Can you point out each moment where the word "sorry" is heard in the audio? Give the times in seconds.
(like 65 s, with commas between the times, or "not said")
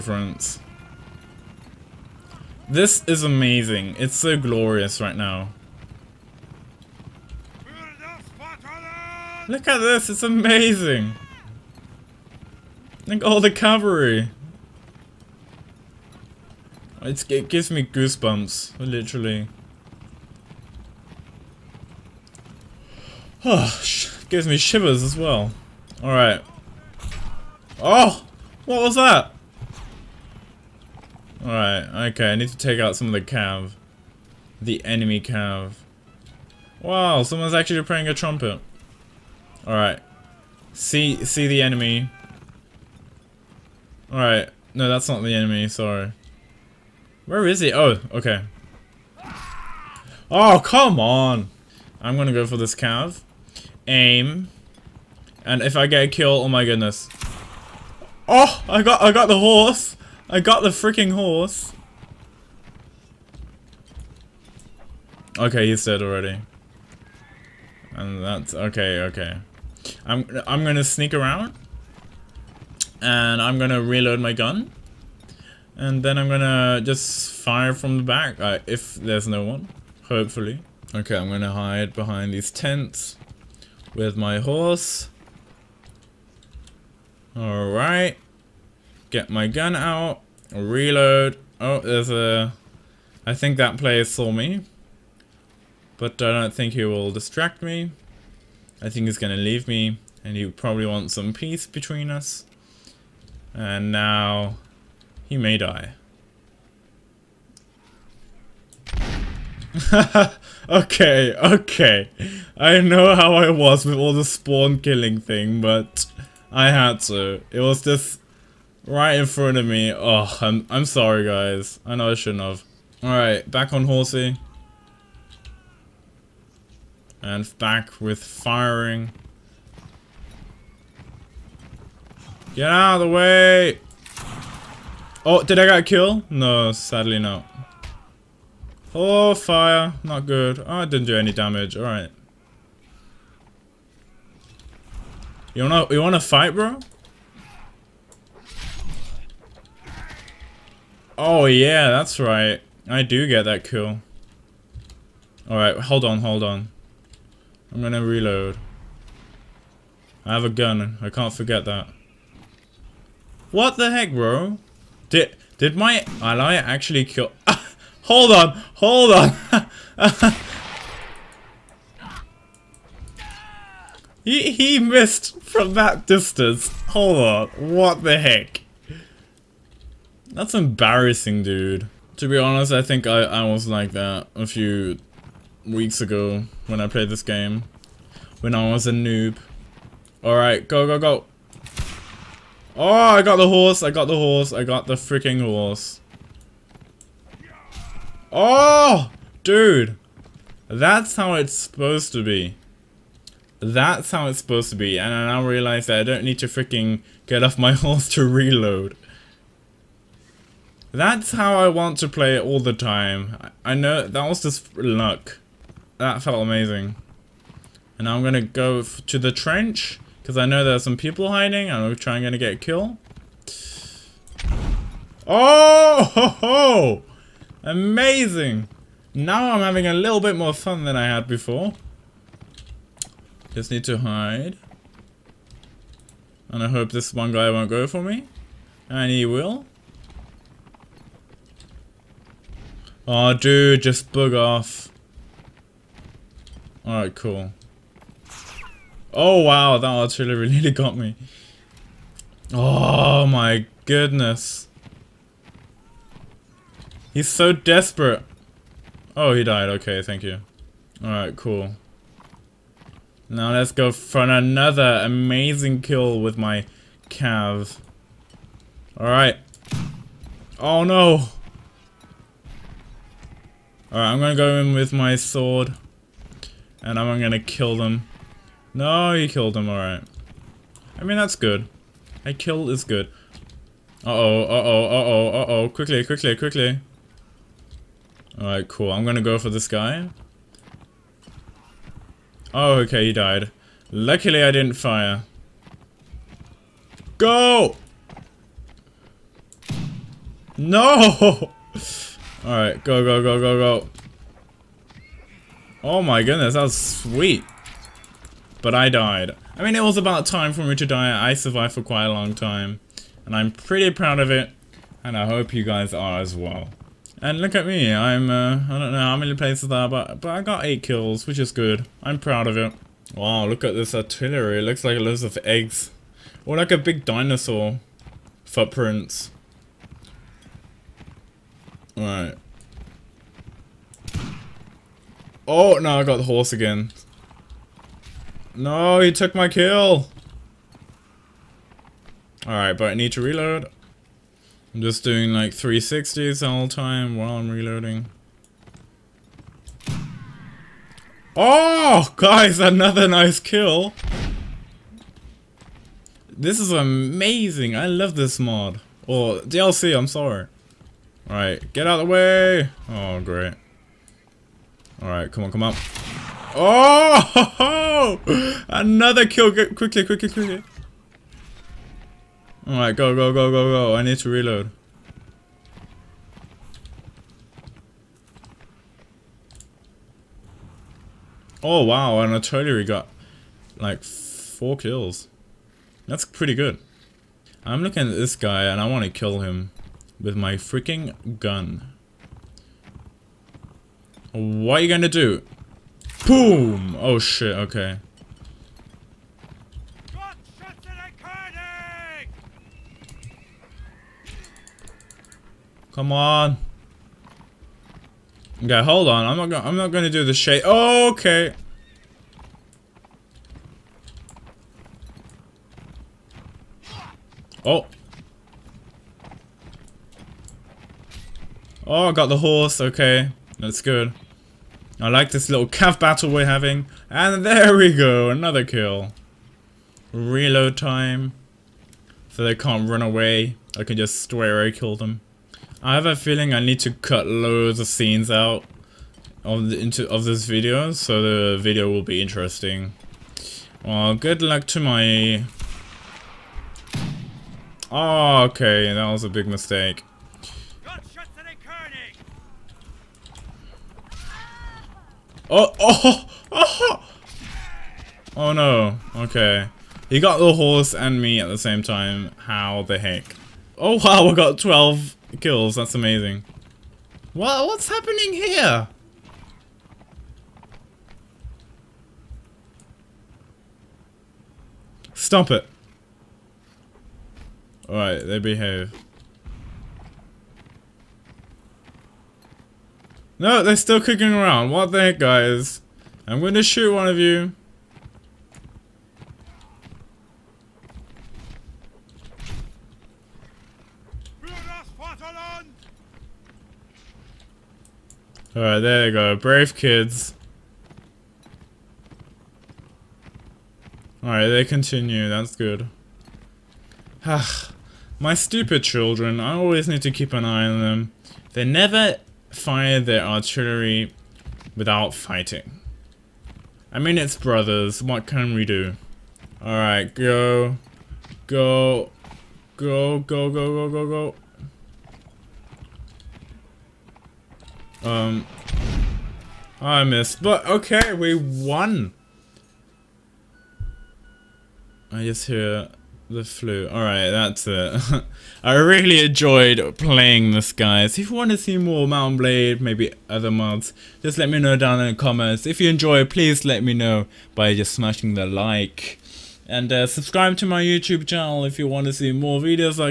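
45 s, 120 s, 360 s.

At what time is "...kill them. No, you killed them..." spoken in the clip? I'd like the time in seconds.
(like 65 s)
277 s.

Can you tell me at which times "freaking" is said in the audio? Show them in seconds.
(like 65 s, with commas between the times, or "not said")
60 s, 194 s, 206 s, 390 s.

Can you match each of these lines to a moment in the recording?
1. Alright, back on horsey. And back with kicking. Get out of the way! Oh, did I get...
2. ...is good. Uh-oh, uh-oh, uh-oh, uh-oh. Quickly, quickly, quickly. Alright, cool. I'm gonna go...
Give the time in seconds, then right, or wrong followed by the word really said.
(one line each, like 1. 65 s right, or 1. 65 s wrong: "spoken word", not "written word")
1. 123 s wrong: "firing", not "kicking"
2. 282 s right.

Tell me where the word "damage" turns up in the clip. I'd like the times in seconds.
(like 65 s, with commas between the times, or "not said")
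141 s.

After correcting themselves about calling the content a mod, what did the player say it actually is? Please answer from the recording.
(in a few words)
DLC.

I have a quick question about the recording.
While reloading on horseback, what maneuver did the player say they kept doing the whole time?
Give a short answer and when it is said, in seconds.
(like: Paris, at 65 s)
360s, at 345 s.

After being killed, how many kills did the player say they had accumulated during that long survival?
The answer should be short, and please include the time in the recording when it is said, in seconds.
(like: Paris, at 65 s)
8, at 320 s.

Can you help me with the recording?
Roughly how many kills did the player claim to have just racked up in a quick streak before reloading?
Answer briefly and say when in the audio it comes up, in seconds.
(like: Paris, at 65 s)
4, at 384 s.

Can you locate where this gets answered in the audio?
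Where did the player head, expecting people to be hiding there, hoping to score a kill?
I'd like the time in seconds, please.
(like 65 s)
219 s.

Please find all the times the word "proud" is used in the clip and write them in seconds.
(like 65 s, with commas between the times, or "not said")
313 s, 322 s.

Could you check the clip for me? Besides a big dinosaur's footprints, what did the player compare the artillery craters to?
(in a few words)
Eggs.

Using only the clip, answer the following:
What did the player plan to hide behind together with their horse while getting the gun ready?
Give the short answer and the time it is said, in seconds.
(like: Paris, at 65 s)
Tents, at 82 s.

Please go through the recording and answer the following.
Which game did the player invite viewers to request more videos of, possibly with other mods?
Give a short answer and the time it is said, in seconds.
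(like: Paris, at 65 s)
Mount and Blade, at 542 s.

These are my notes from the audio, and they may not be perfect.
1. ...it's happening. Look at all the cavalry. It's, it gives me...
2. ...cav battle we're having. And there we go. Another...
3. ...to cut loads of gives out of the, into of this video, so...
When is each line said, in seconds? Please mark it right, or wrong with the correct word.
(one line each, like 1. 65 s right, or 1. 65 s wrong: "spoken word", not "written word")
1. 10 s wrong: "amazing", not "happening"
2. 425 s right
3. 436 s wrong: "scenes", not "gives".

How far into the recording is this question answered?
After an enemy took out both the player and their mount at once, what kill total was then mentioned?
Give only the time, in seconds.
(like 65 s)
464 s.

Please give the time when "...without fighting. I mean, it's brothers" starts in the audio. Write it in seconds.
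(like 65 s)
514 s.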